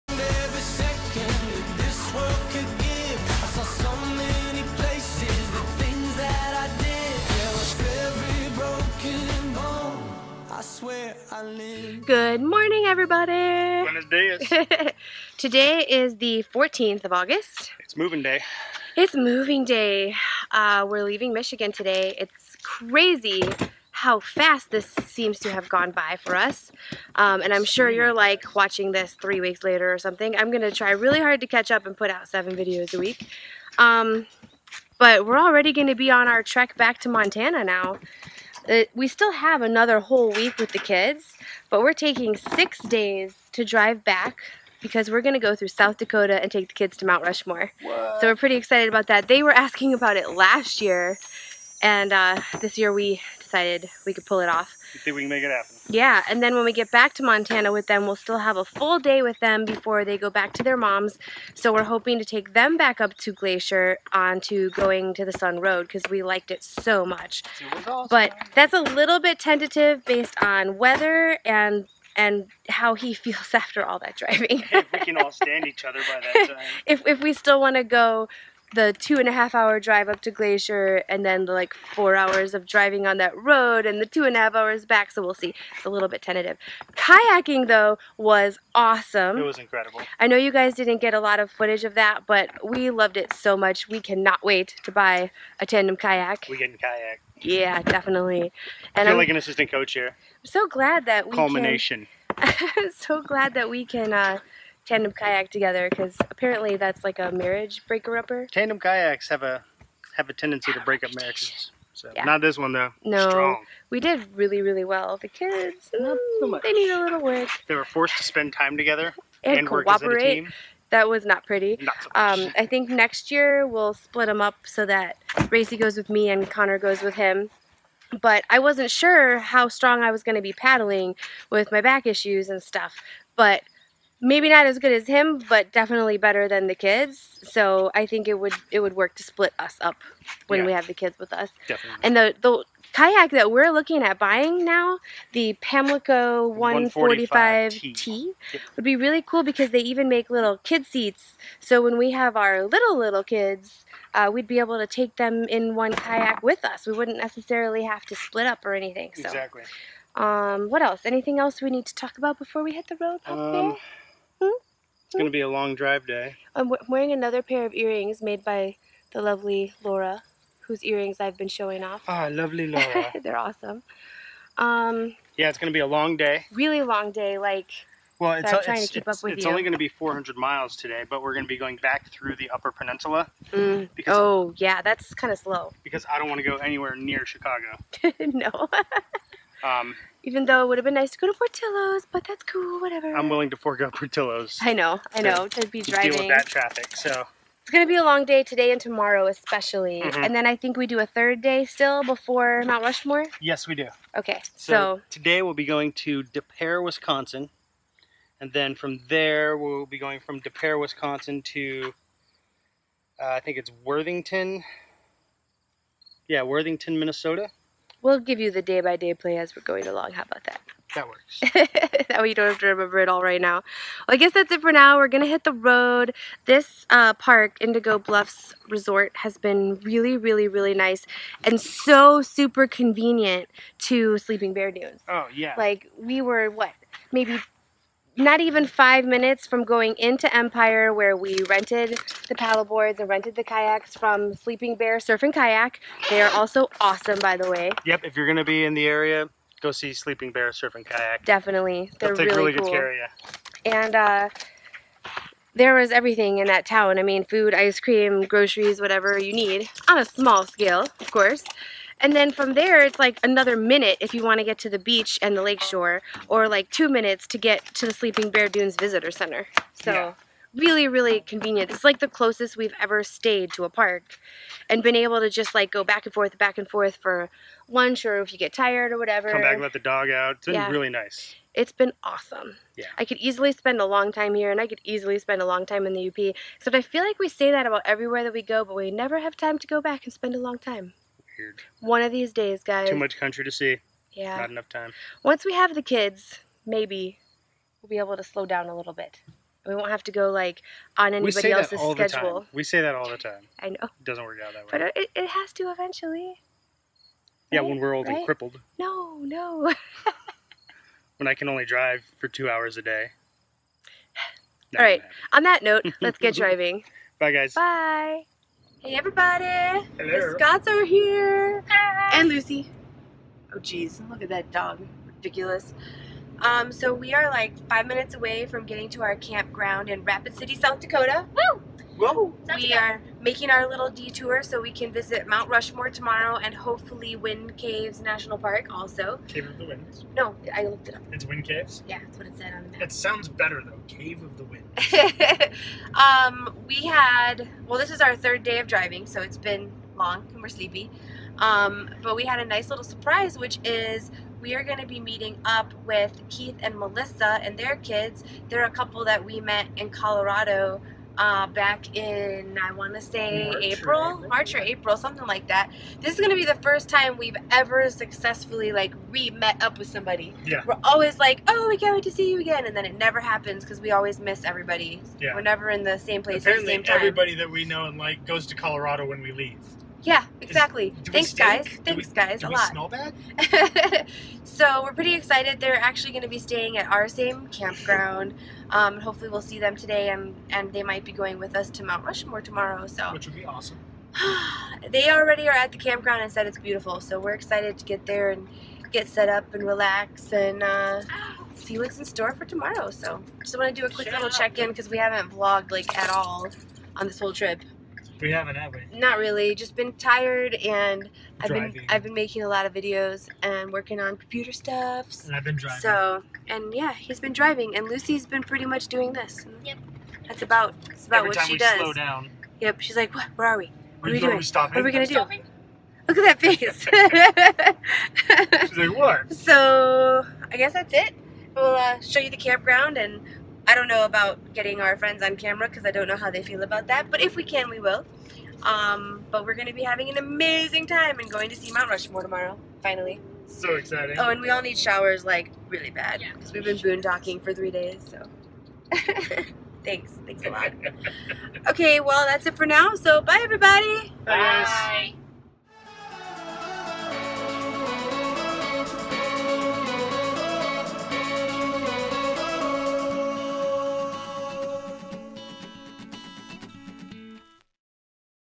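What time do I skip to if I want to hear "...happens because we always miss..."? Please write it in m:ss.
6:13.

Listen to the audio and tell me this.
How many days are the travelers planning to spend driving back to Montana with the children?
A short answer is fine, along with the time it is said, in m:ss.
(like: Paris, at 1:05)
6, at 0:42.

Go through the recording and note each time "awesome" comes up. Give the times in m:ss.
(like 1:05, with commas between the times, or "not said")
1:07, 1:28, 2:53, 4:06, 4:42, 6:33.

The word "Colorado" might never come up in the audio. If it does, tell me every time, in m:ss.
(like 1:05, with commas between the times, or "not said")
5:59, 6:18.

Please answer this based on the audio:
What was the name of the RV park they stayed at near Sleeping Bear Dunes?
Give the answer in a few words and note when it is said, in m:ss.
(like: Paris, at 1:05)
Indigo Bluffs Resort, at 3:47.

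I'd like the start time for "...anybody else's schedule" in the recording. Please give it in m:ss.
5:01.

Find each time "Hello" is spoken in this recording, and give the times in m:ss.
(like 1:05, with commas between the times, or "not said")
5:19.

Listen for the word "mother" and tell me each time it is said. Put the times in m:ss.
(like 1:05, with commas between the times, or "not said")
not said.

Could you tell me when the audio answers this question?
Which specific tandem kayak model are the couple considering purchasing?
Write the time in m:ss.
2:25.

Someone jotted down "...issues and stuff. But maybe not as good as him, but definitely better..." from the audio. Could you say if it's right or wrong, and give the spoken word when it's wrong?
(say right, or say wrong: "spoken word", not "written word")
right.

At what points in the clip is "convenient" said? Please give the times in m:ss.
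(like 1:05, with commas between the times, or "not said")
3:52, 4:31.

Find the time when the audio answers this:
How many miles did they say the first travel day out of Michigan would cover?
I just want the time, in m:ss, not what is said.
2:59.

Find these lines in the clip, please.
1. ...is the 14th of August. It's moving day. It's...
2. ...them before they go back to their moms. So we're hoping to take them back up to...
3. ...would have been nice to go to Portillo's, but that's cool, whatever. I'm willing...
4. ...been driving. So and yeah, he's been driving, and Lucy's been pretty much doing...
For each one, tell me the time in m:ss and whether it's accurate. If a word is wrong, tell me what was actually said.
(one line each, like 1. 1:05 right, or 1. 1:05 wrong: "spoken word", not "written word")
1. 0:15 right
2. 0:59 right
3. 3:10 right
4. 6:55 right.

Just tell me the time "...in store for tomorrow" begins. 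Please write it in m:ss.
6:41.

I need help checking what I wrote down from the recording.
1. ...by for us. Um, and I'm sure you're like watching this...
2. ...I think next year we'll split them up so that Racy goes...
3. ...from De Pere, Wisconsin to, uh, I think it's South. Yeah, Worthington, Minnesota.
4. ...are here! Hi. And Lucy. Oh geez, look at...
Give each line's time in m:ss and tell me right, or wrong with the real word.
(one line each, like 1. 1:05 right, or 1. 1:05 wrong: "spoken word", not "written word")
1. 0:25 right
2. 2:02 right
3. 3:30 wrong: "Worthington", not "South"
4. 5:20 right.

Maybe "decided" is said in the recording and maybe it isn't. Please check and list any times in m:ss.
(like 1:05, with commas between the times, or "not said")
0:53.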